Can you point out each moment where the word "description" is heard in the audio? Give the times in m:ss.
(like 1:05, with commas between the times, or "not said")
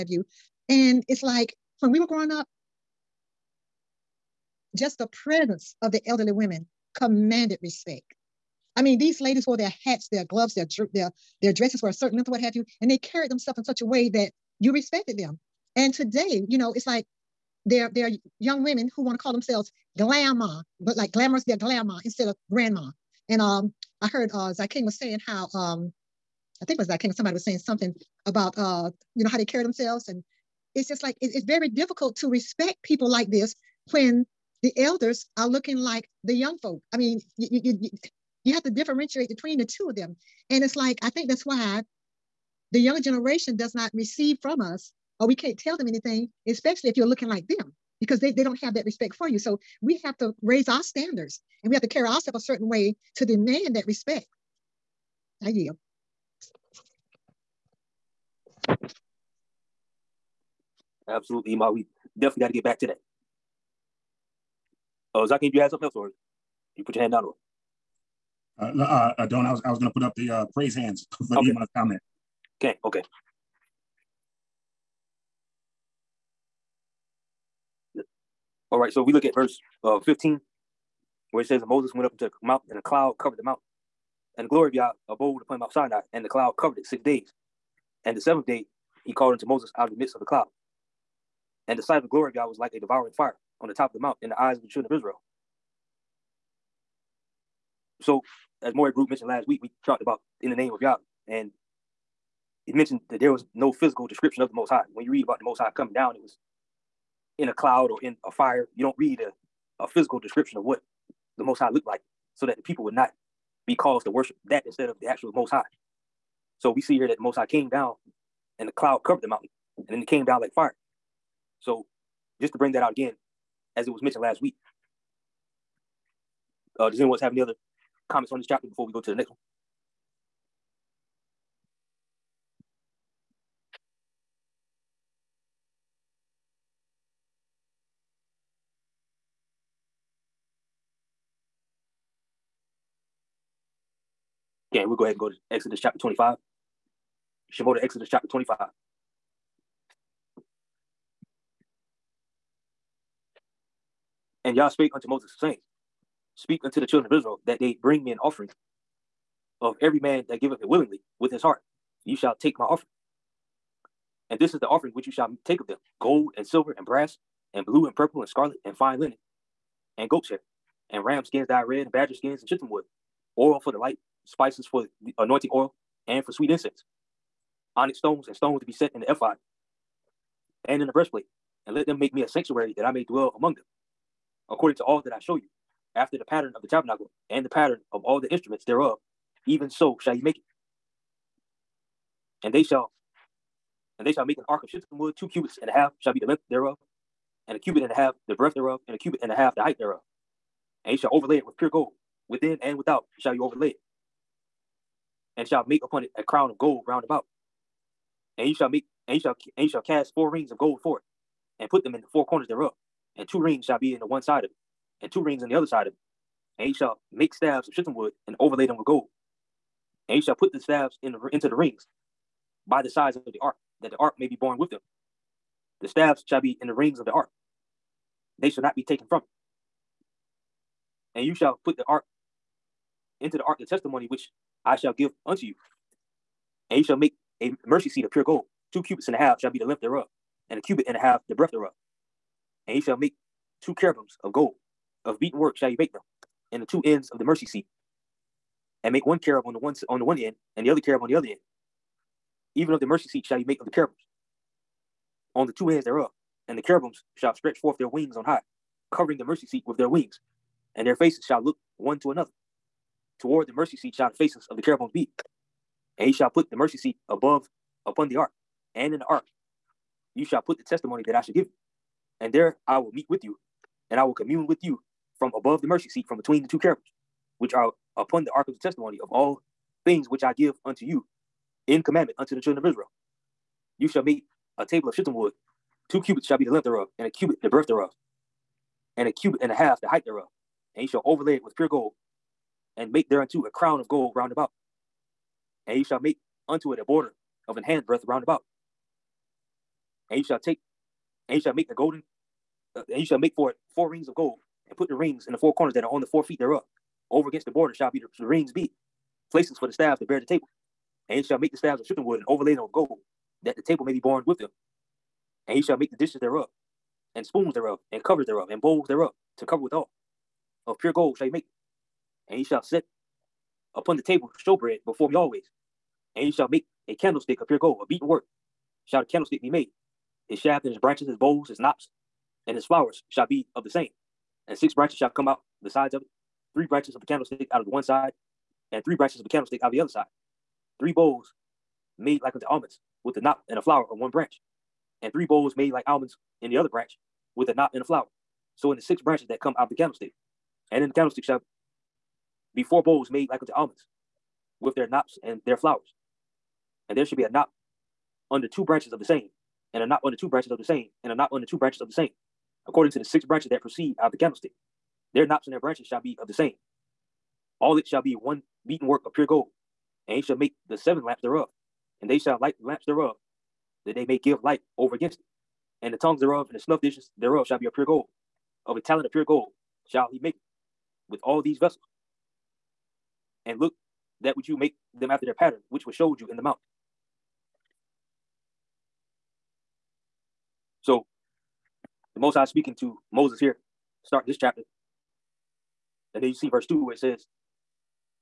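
1:44, 1:50.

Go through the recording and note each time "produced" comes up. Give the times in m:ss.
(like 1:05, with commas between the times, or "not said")
not said.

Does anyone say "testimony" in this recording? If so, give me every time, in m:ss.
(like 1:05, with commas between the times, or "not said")
3:53, 4:30, 4:38.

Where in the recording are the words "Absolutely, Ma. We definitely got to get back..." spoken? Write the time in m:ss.
1:01.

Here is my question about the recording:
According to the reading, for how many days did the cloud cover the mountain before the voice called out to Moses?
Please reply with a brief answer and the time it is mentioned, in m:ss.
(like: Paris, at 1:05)
6 days, at 1:26.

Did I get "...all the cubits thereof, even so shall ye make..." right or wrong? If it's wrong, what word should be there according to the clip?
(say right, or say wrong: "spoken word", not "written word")
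wrong: "instruments", not "cubits".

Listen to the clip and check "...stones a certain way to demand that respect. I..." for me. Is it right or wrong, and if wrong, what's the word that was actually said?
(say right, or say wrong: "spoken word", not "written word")
wrong: "ourselves", not "stones".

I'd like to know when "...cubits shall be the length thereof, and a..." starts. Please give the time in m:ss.
4:46.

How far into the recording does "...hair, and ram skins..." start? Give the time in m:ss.
2:50.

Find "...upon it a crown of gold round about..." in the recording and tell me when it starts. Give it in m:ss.
3:25.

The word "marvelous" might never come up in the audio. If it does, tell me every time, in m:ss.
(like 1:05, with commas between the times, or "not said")
not said.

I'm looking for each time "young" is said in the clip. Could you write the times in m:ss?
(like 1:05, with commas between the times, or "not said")
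0:18, 0:36, 0:42.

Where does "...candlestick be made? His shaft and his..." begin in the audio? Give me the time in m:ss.
5:29.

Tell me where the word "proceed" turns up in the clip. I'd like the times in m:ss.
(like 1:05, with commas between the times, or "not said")
6:03.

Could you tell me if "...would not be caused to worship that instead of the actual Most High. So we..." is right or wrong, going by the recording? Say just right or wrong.
right.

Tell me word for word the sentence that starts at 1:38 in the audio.
So, as Maury Group mentioned last week, we talked about in the name of Yah.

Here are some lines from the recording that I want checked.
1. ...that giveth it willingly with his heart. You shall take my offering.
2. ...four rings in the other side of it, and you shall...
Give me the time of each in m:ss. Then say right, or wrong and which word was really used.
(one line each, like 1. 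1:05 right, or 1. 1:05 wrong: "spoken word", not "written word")
1. 2:40 right
2. 3:35 wrong: "two", not "four".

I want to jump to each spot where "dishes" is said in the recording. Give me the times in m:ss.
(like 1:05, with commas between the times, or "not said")
5:15, 6:16.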